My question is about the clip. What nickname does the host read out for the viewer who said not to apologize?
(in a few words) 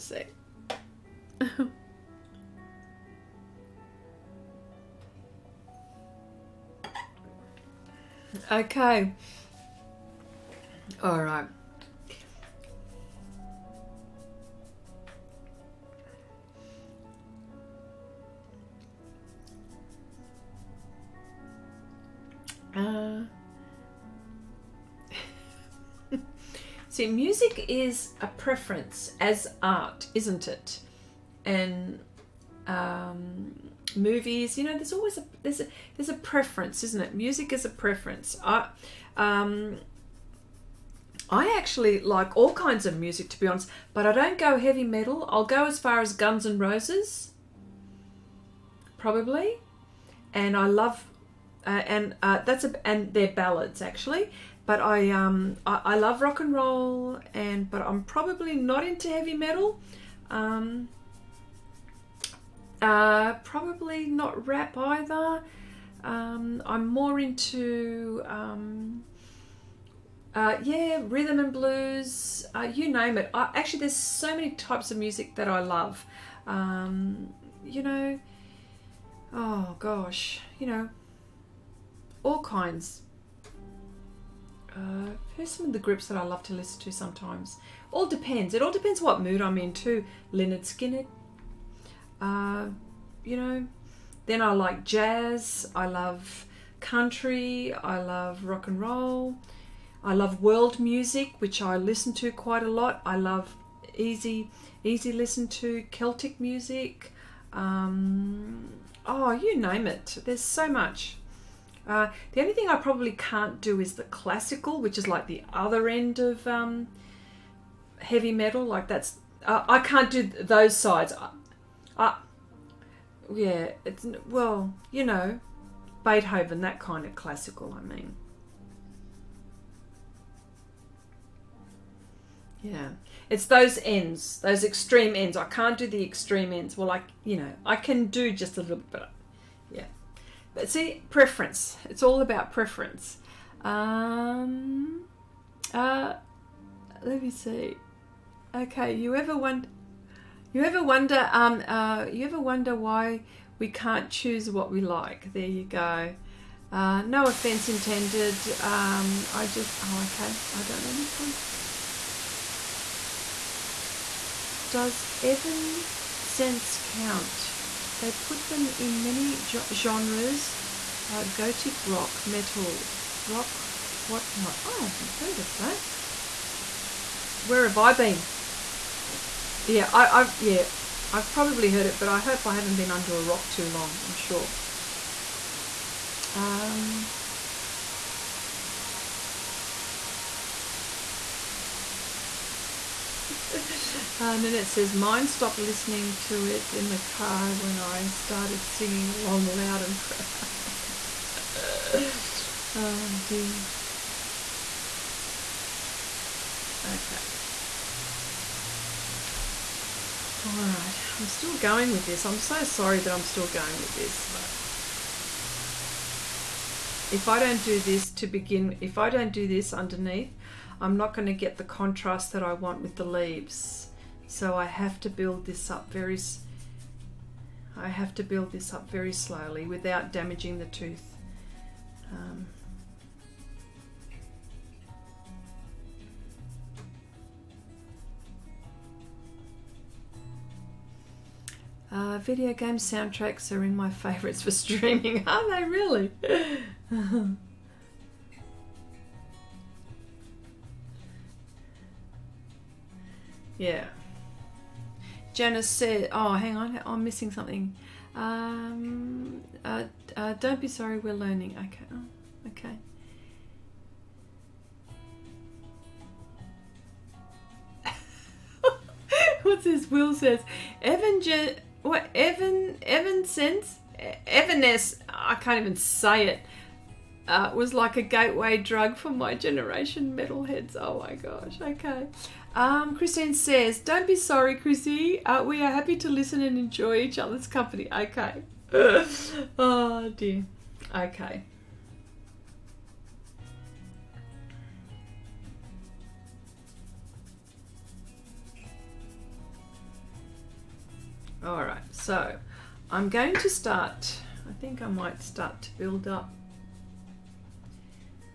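Chrissy.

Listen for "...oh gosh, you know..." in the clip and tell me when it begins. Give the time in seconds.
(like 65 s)
79 s.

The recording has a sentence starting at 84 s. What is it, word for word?
Uh, here's some of the groups that I love to listen to sometimes.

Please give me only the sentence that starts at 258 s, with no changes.
Um, uh, uh, don't be sorry, we're learning.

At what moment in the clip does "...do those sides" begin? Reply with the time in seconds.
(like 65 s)
120 s.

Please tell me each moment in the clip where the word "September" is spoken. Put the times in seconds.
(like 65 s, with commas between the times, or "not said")
not said.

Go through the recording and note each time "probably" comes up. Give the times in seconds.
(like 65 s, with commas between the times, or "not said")
48 s, 58 s, 63 s, 112 s, 181 s.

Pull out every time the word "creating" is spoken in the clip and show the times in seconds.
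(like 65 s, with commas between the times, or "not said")
not said.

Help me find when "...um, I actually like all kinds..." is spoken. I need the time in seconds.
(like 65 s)
39 s.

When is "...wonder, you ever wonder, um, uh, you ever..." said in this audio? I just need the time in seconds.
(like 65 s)
149 s.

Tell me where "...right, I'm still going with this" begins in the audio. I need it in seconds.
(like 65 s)
210 s.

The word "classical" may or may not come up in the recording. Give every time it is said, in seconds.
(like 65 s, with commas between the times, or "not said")
114 s, 127 s.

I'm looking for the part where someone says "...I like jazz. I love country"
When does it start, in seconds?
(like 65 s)
94 s.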